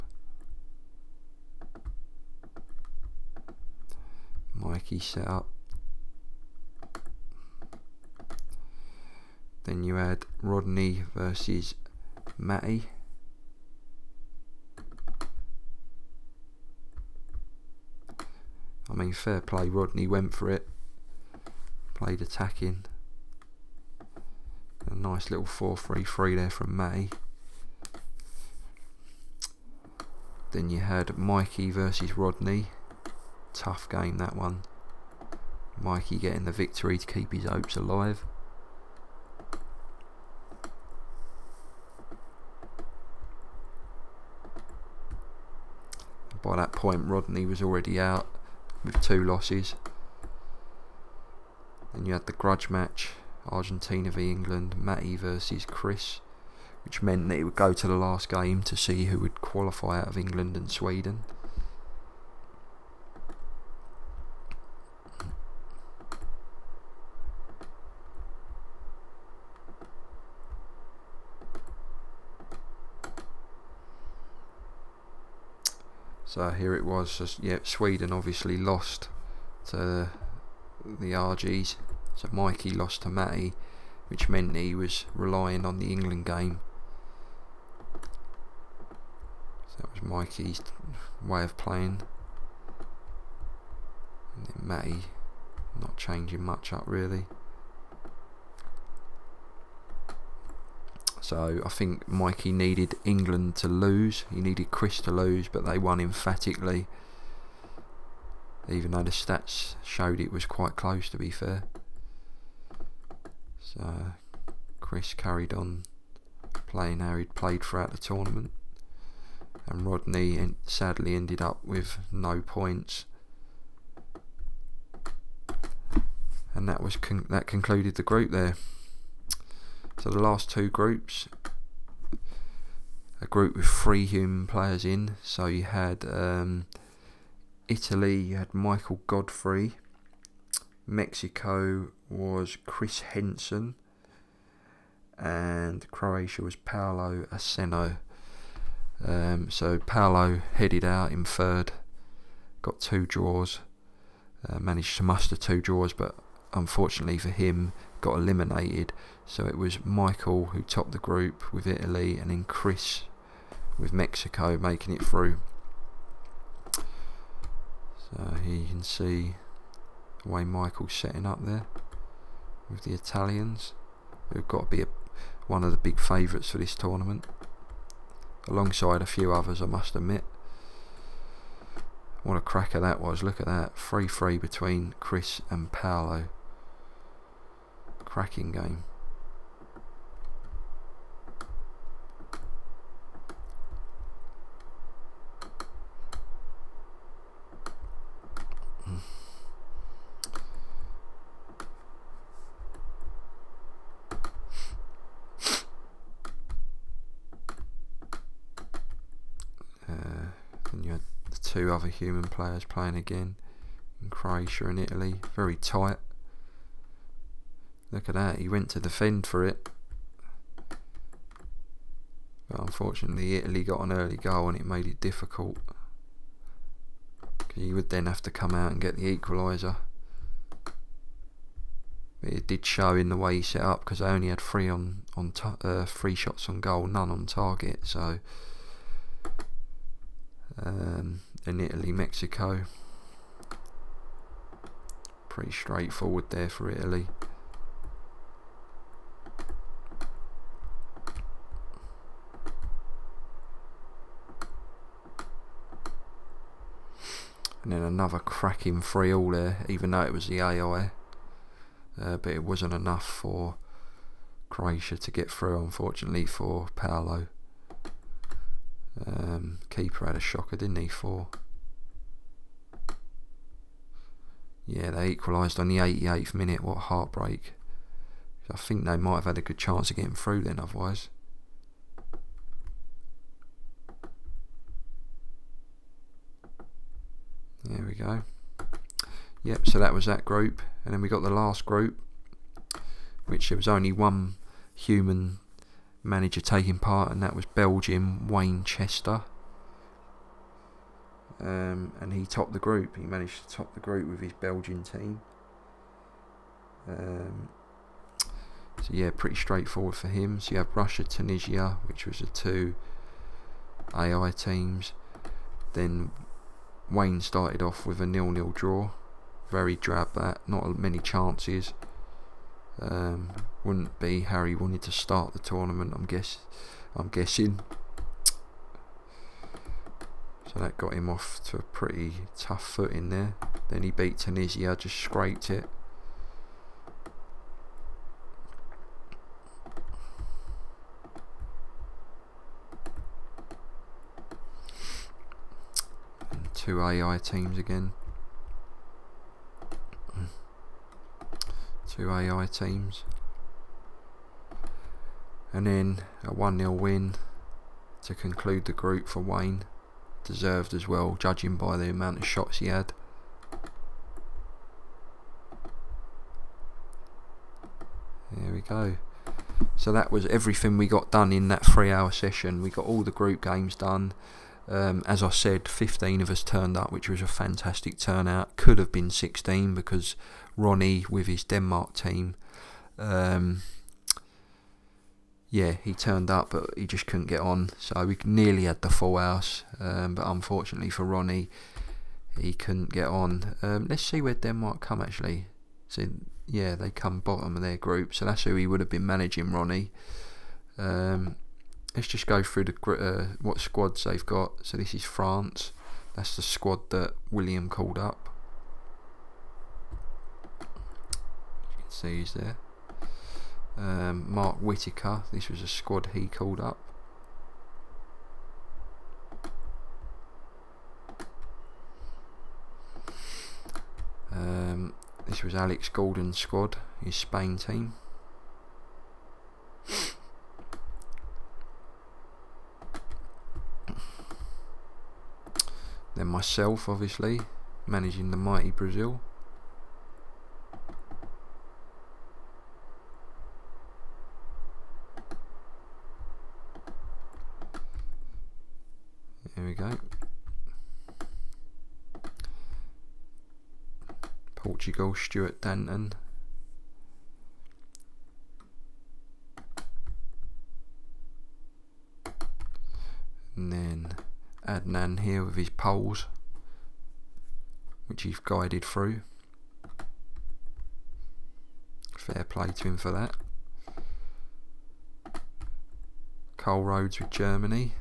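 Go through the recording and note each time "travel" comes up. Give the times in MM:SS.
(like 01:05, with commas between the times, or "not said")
not said.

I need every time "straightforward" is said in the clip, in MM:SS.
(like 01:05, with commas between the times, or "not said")
04:05, 05:09.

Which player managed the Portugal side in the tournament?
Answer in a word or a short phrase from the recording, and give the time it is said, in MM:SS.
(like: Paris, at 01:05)
Stuart Denton, at 07:35.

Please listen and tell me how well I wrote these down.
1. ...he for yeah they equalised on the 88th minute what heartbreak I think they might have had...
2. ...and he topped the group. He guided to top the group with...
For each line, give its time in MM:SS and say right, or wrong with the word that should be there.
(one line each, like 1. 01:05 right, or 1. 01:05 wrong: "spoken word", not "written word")
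1. 04:30 right
2. 05:01 wrong: "managed", not "guided".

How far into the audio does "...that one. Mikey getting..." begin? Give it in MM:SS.
00:34.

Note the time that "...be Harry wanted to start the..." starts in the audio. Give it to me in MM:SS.
05:23.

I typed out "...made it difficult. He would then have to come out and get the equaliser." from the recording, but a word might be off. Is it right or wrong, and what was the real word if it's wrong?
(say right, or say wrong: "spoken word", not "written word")
right.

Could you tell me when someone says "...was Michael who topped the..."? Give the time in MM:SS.
02:39.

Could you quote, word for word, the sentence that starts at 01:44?
He needed Chris to lose, but they won emphatically.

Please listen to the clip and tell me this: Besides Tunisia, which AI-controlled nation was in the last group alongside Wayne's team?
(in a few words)
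Russia.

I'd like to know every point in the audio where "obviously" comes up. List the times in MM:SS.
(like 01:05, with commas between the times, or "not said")
01:18, 07:16.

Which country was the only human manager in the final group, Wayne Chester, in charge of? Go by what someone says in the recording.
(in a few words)
Belgium.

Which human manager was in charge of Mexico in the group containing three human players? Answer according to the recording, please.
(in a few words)
Chris Henson.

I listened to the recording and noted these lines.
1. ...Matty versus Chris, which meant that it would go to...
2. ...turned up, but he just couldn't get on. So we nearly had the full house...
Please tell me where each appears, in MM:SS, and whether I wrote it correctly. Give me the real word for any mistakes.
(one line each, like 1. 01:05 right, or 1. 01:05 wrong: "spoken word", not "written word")
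1. 00:54 right
2. 06:25 right.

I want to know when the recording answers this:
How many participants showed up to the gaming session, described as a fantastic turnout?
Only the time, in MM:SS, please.
06:15.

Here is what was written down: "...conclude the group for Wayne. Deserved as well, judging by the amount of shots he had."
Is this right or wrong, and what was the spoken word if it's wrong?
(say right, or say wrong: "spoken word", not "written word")
right.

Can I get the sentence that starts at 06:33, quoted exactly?
Um, let's see where Denmark come actually.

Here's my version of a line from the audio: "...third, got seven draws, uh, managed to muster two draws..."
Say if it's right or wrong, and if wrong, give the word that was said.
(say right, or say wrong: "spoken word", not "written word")
wrong: "two", not "seven".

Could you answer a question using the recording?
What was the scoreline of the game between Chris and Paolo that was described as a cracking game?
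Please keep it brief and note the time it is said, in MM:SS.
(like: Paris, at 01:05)
3-3, at 03:03.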